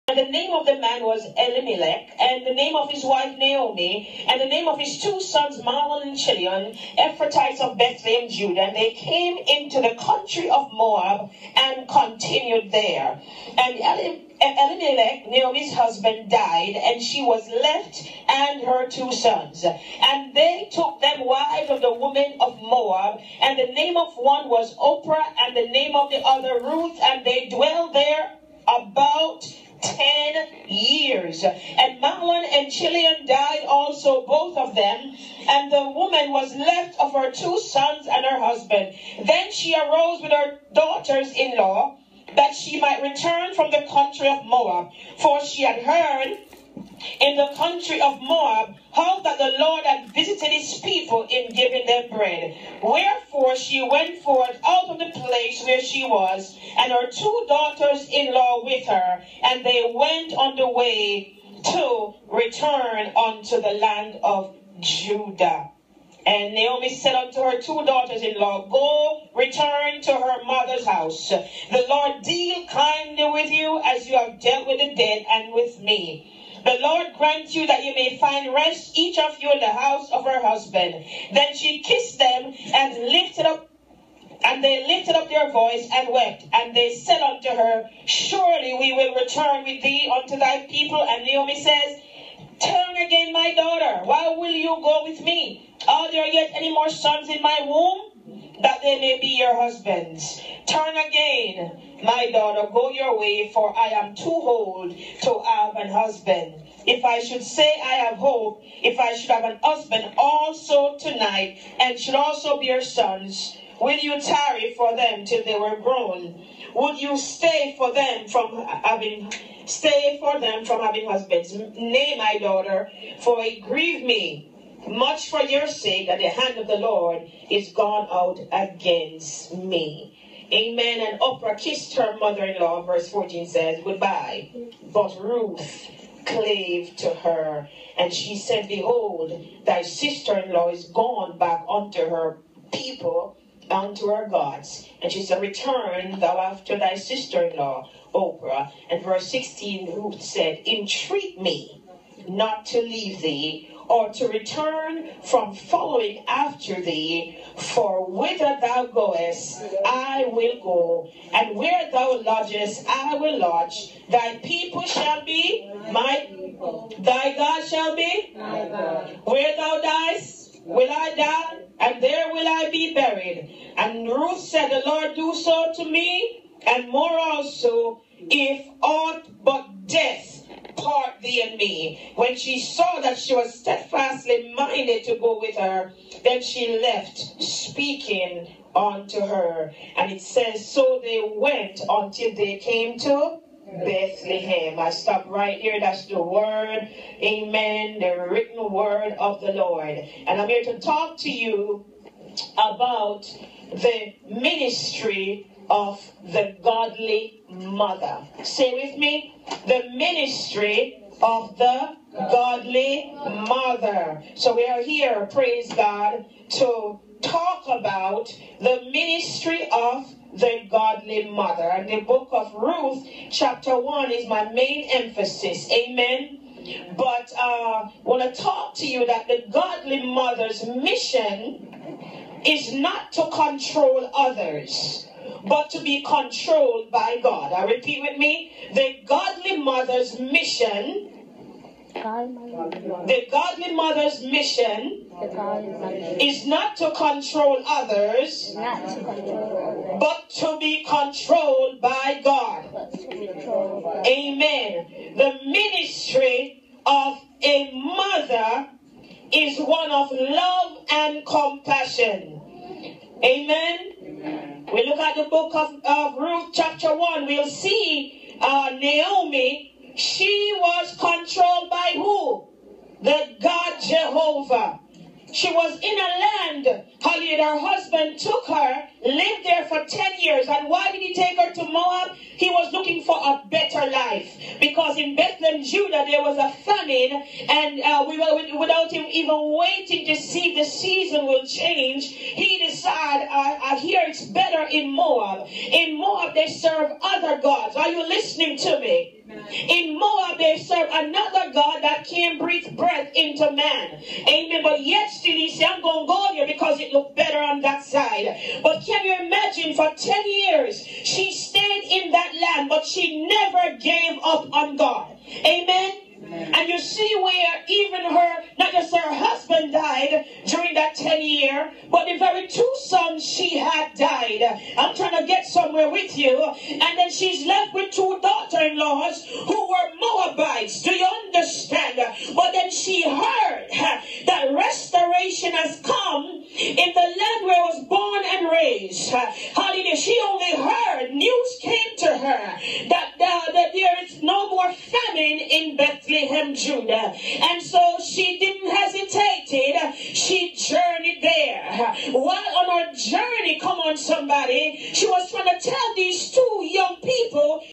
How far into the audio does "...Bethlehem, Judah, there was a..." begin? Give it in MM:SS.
04:45.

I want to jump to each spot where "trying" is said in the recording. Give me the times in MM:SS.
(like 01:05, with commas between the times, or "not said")
05:24, 05:55.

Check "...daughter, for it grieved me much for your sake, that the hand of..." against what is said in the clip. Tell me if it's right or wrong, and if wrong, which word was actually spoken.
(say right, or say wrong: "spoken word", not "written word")
right.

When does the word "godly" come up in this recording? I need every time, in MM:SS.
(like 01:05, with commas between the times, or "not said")
03:26, 03:32, 03:40, 03:49, 03:59, 04:03.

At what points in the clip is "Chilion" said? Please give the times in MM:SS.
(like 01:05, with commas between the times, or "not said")
00:06, 00:32.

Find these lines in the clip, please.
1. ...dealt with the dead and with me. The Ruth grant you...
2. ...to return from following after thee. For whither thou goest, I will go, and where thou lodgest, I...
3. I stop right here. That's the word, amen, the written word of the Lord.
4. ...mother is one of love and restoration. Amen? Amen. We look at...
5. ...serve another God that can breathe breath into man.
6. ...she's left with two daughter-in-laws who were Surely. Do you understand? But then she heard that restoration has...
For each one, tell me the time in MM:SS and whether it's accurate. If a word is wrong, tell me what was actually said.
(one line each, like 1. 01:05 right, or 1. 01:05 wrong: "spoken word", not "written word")
1. 01:14 wrong: "Lord", not "Ruth"
2. 02:34 right
3. 03:14 right
4. 04:17 wrong: "compassion", not "restoration"
5. 05:00 right
6. 05:27 wrong: "Moabites", not "Surely".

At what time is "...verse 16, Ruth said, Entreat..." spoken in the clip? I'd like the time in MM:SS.
02:29.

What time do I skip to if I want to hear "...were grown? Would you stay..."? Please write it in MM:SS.
01:55.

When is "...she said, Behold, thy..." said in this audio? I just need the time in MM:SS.
02:18.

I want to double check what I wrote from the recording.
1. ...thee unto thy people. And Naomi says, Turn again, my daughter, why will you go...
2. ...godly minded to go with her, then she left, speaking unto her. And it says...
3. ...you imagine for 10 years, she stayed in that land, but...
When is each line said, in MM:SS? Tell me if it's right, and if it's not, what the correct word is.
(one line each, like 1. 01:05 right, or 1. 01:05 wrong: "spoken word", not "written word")
1. 01:29 right
2. 03:03 wrong: "steadfastly", not "godly"
3. 05:09 right.